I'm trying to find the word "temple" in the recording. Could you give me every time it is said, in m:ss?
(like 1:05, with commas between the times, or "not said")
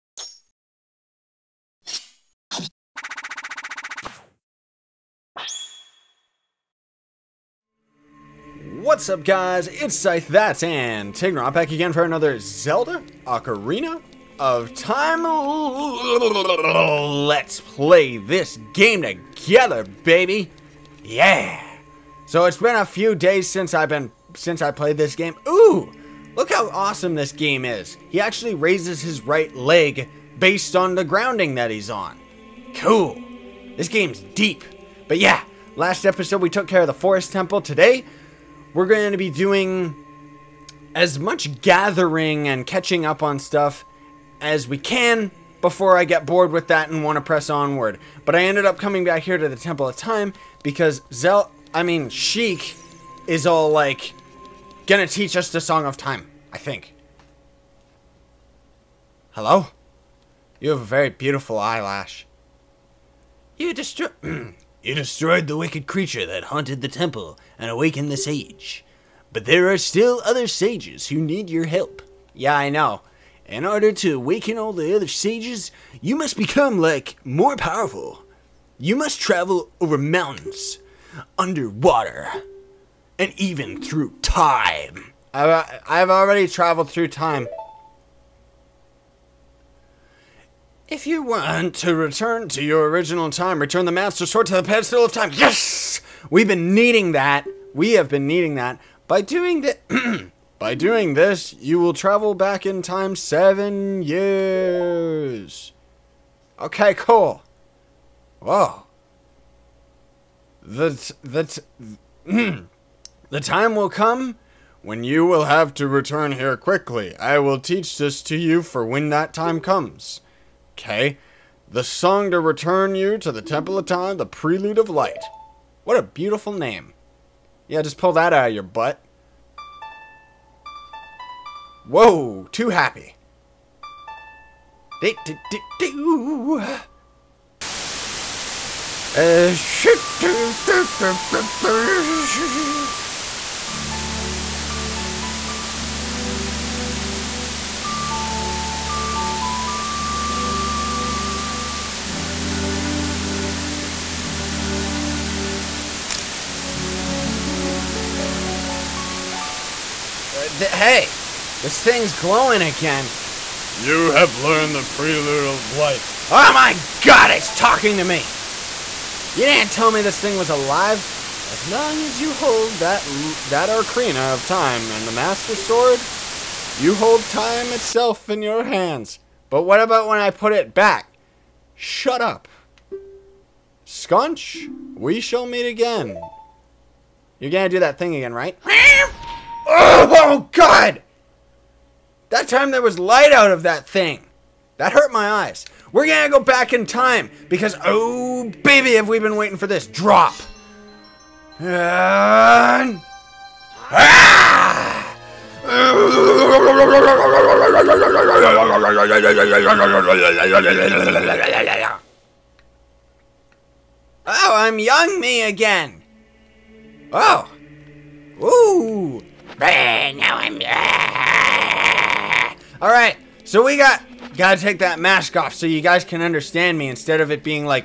0:37, 0:49, 1:06, 2:03.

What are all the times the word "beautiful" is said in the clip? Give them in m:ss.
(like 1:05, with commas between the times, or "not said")
1:01, 2:06.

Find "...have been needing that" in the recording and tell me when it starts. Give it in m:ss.
1:37.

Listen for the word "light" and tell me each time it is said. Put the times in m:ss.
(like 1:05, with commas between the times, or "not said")
2:04, 2:45, 3:12.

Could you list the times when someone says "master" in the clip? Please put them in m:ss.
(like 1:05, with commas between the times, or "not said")
1:33, 2:55.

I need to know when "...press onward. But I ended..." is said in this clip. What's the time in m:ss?
0:47.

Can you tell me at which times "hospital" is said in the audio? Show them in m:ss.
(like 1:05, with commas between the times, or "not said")
not said.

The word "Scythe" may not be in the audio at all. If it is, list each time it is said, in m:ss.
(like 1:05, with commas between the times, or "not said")
0:09.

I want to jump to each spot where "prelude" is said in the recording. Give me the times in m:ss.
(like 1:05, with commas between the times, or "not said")
2:04, 2:44.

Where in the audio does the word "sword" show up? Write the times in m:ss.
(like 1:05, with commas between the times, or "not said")
1:34, 2:55.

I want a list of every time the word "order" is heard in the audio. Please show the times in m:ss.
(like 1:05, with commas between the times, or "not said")
1:13.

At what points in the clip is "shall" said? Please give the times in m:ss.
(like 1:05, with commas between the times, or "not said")
3:05.